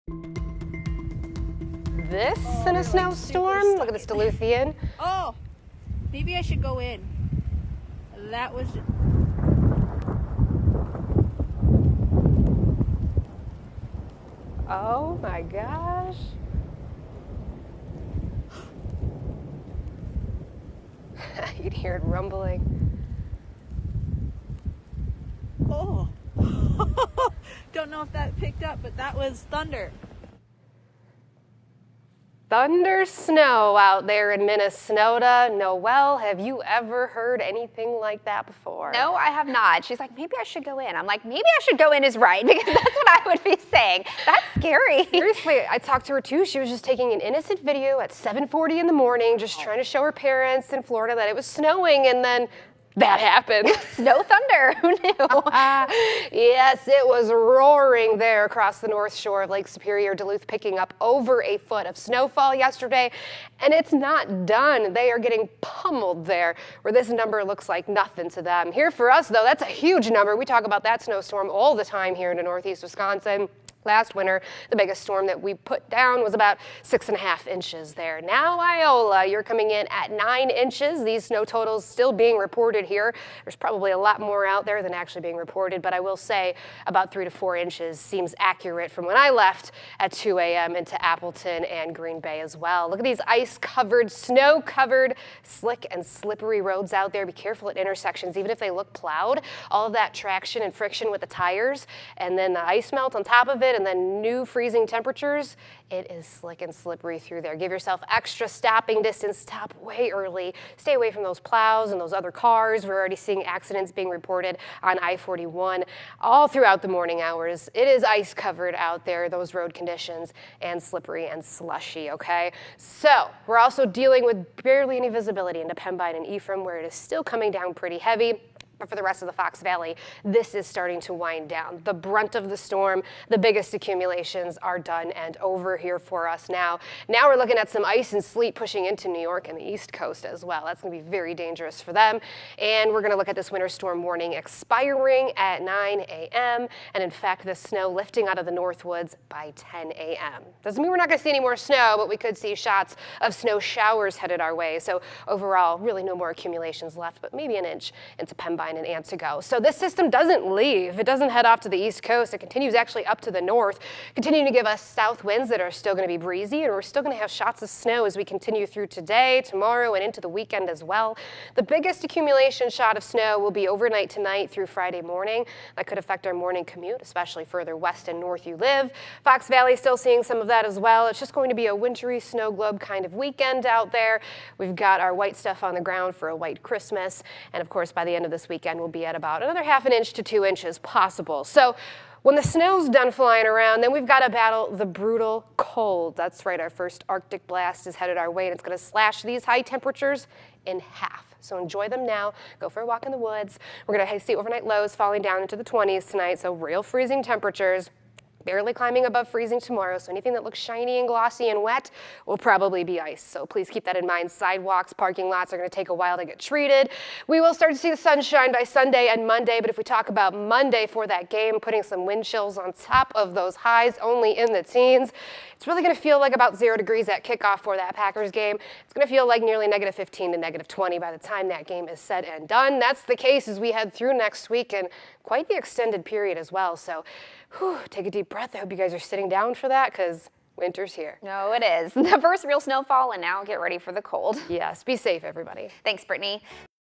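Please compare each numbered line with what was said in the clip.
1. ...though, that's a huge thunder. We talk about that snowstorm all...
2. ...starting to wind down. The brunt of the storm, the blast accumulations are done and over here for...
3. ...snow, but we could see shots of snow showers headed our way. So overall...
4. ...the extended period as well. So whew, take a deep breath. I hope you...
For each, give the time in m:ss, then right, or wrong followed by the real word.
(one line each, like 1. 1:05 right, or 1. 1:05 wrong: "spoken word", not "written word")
1. 1:09 wrong: "number", not "thunder"
2. 2:10 wrong: "biggest", not "blast"
3. 2:31 right
4. 3:55 right.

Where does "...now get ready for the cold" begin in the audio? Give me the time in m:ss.
4:03.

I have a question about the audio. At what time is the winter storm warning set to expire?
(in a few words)
9 a.m.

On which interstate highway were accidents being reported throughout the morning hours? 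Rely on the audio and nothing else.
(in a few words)
I-41.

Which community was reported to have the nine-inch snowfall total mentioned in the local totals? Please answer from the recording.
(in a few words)
Iola.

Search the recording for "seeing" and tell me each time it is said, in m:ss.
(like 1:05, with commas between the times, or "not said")
1:53, 2:59.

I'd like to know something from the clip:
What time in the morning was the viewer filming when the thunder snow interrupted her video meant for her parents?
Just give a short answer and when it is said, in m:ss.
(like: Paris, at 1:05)
7:40, at 0:48.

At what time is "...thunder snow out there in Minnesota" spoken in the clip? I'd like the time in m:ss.
0:32.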